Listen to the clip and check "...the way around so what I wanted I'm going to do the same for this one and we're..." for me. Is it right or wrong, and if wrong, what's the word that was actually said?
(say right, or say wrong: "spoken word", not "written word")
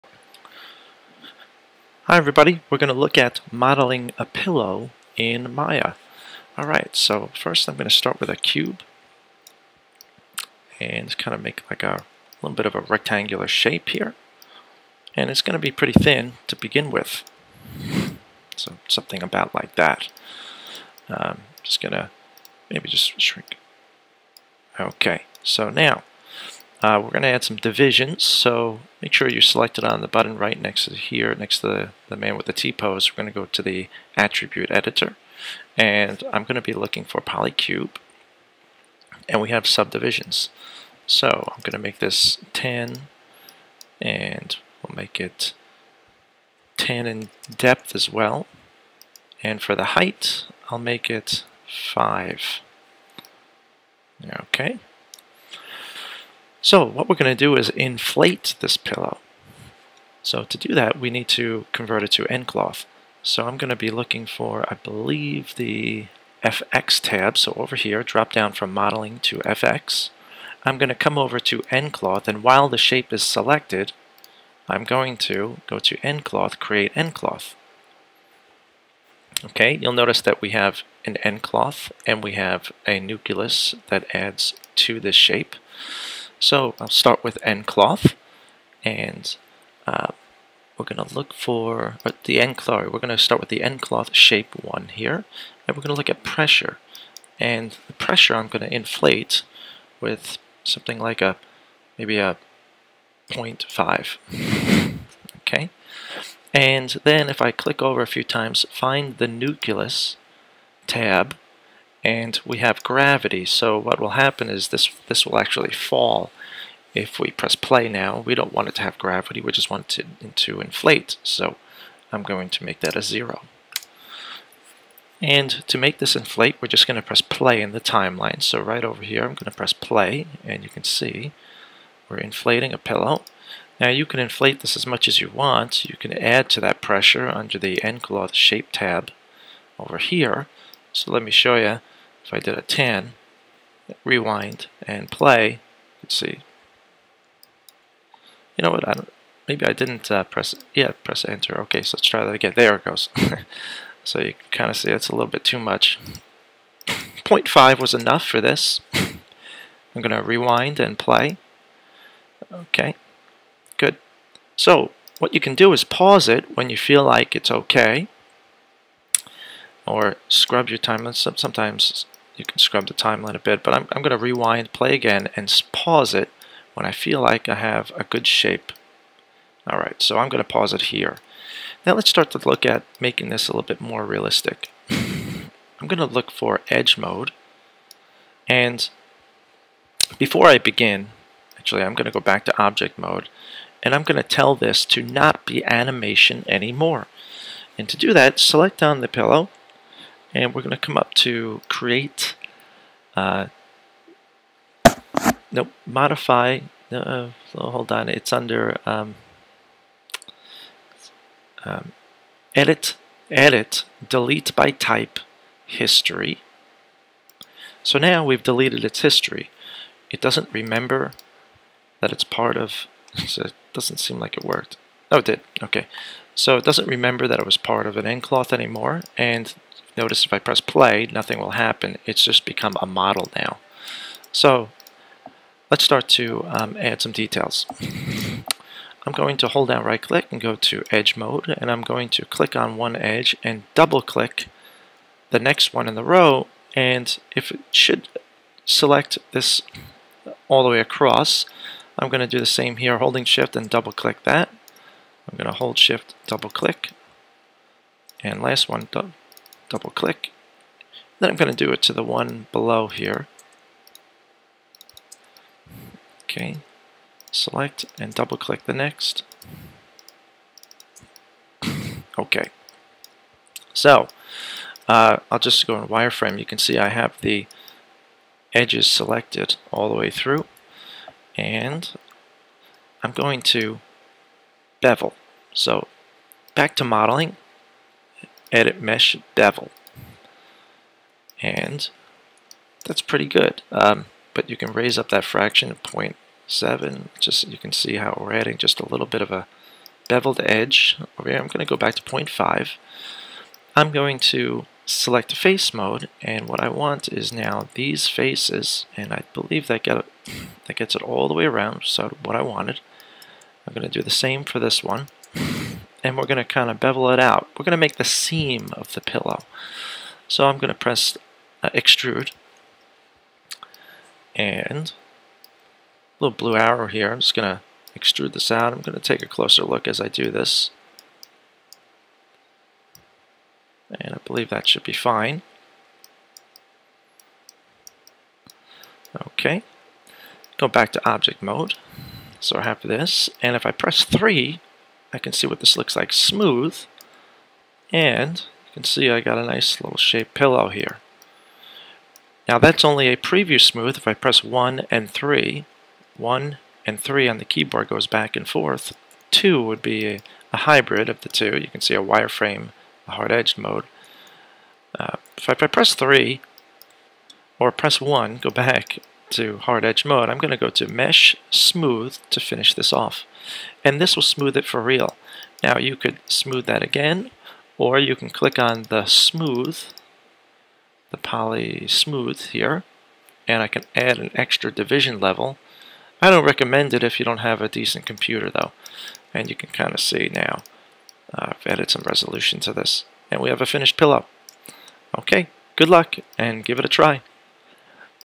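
right.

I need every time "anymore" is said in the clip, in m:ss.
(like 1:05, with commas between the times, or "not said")
3:16, 3:48.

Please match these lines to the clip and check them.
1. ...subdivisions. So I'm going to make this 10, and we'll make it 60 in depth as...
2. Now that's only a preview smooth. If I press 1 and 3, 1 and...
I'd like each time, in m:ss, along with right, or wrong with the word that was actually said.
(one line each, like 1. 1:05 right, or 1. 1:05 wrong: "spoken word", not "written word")
1. 0:39 wrong: "10", not "60"
2. 5:52 right.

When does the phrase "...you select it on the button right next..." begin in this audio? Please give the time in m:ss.
0:29.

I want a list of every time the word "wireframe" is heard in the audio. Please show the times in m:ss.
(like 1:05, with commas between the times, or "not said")
4:35, 6:02.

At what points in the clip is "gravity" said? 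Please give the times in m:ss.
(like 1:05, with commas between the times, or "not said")
1:52, 1:58.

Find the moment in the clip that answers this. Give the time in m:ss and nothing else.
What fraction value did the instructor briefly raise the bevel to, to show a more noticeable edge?
4:55.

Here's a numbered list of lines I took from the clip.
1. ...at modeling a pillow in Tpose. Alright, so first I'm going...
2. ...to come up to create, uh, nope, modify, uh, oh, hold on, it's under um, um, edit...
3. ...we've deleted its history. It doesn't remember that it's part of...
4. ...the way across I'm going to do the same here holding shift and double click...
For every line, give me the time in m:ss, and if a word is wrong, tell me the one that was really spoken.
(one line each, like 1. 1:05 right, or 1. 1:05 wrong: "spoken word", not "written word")
1. 0:03 wrong: "Maya", not "Tpose"
2. 3:20 right
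3. 3:38 right
4. 4:10 right.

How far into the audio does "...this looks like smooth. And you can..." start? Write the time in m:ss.
5:45.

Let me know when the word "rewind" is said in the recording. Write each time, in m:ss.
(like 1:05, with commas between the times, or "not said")
2:24, 2:40, 2:54.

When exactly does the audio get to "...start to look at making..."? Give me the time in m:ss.
3:02.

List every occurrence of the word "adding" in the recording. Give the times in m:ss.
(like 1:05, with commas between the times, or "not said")
4:58.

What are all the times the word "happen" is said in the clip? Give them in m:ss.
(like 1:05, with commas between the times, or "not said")
1:54, 3:51.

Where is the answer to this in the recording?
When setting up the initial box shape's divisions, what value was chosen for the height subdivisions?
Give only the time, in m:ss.
0:51.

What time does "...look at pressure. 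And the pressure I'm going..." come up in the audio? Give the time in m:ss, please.
1:35.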